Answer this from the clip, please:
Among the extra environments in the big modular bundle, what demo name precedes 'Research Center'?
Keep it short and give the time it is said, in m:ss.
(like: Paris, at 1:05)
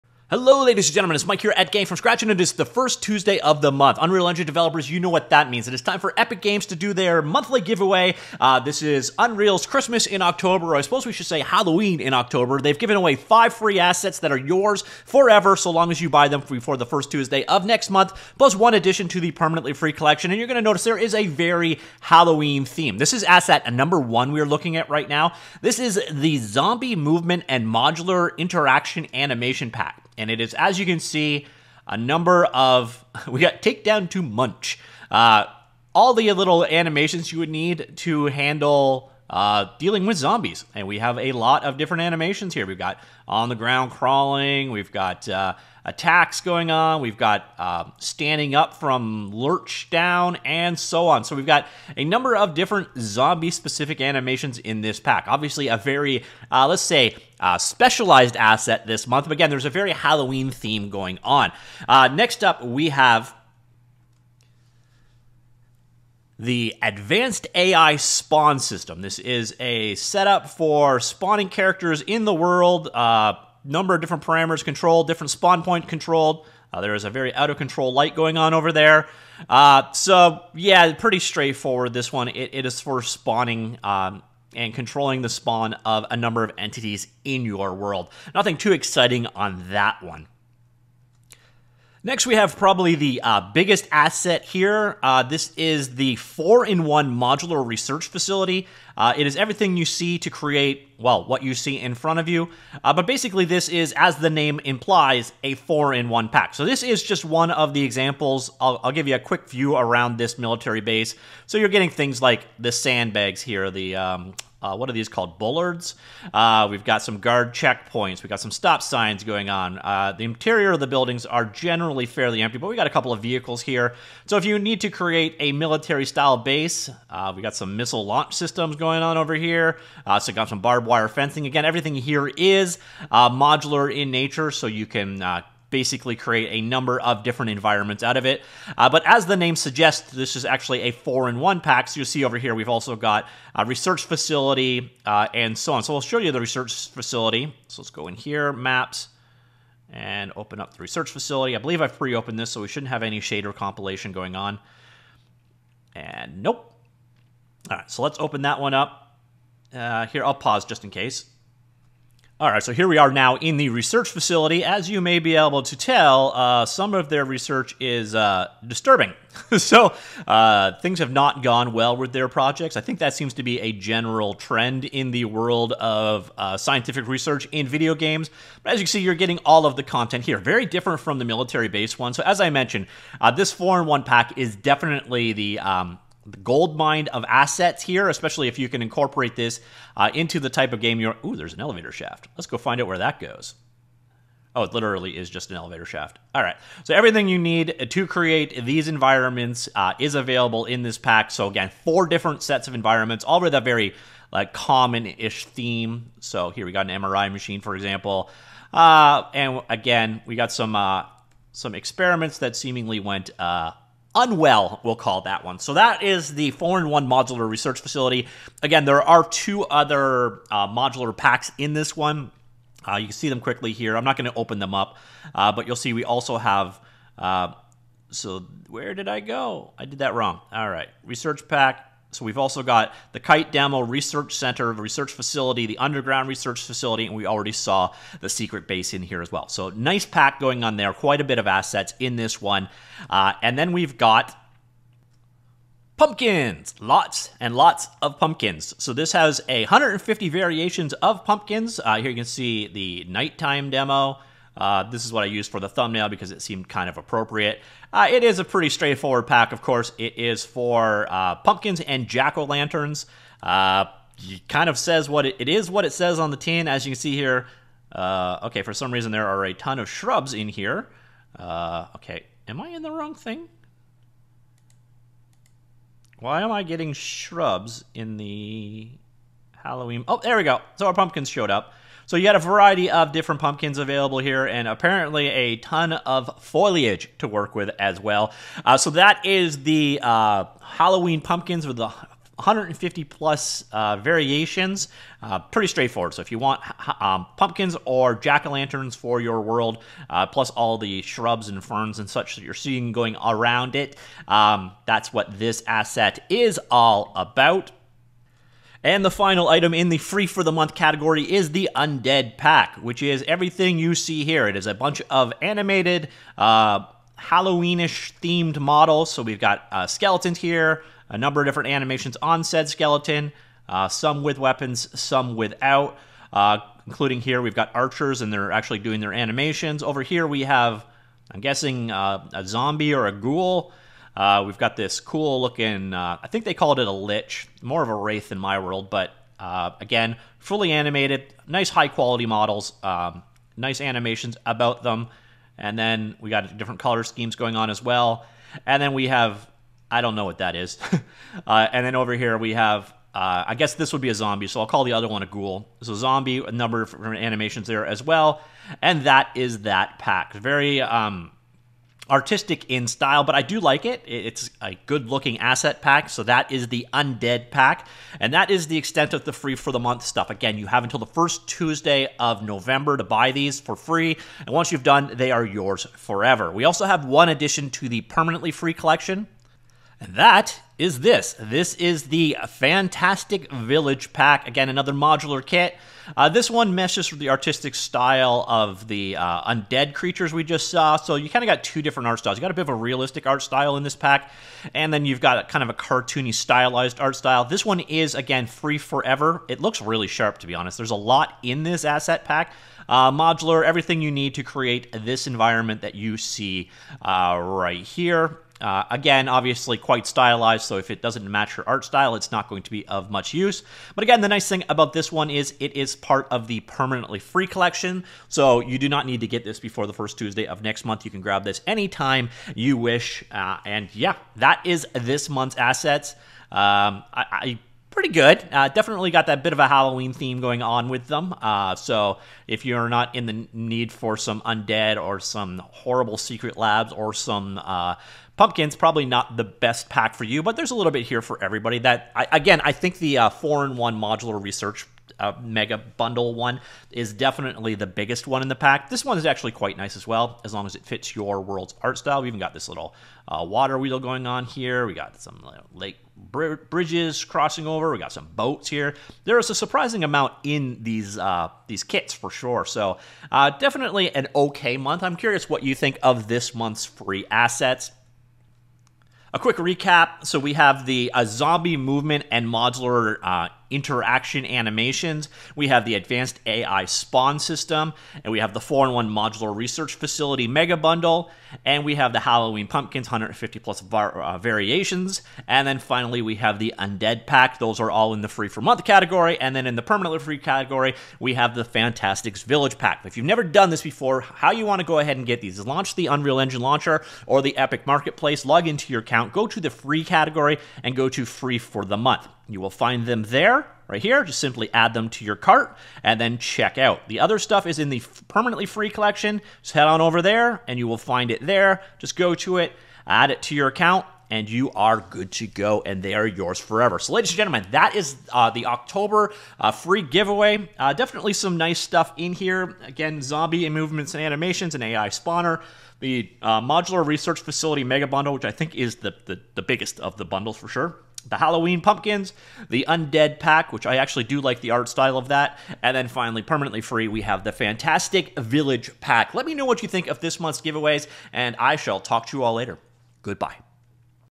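Kite Demo, at 3:53.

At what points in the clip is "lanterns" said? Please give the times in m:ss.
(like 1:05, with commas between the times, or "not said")
4:22, 4:58.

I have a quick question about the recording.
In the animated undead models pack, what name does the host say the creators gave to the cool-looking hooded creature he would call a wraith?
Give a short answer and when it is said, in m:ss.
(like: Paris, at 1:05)
lich, at 5:36.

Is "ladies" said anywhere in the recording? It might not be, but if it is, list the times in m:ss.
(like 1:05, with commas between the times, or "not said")
0:00, 8:37.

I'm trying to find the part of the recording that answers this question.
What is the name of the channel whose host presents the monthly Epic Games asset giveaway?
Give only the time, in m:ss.
0:01.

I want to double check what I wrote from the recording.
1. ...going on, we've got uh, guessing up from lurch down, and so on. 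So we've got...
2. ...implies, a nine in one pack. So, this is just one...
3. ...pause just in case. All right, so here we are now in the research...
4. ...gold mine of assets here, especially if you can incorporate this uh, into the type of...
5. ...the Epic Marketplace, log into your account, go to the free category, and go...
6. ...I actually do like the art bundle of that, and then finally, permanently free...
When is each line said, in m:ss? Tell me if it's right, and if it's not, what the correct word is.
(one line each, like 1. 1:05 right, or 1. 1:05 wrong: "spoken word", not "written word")
1. 0:46 wrong: "standing", not "guessing"
2. 1:44 wrong: "four", not "nine"
3. 2:40 right
4. 3:06 right
5. 8:17 right
6. 8:53 wrong: "style", not "bundle".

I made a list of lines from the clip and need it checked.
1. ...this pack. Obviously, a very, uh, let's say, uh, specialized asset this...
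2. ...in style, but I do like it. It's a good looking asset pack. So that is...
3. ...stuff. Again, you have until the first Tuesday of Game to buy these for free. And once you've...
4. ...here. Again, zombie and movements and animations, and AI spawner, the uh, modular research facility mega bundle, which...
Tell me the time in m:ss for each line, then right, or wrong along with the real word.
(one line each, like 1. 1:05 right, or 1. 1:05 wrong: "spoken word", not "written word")
1. 0:54 right
2. 6:02 right
3. 6:10 wrong: "November", not "Game"
4. 8:42 right.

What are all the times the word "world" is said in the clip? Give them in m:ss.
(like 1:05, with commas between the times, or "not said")
1:12, 1:27, 2:55, 4:59, 5:38, 7:31.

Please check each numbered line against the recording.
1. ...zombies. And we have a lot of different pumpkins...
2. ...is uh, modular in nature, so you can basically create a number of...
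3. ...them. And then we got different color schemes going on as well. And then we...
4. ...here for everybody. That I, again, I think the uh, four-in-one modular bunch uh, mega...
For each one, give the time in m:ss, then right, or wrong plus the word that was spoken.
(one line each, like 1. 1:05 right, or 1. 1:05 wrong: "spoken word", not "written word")
1. 0:40 wrong: "animations", not "pumpkins"
2. 2:12 right
3. 5:44 right
4. 7:21 wrong: "research", not "bunch".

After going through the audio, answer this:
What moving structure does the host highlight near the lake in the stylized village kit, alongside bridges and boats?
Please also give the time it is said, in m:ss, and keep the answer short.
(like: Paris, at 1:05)
water wheel, at 7:33.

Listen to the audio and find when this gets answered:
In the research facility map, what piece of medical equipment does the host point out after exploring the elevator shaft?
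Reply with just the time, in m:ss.
3:27.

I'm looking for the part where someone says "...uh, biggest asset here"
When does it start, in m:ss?
1:33.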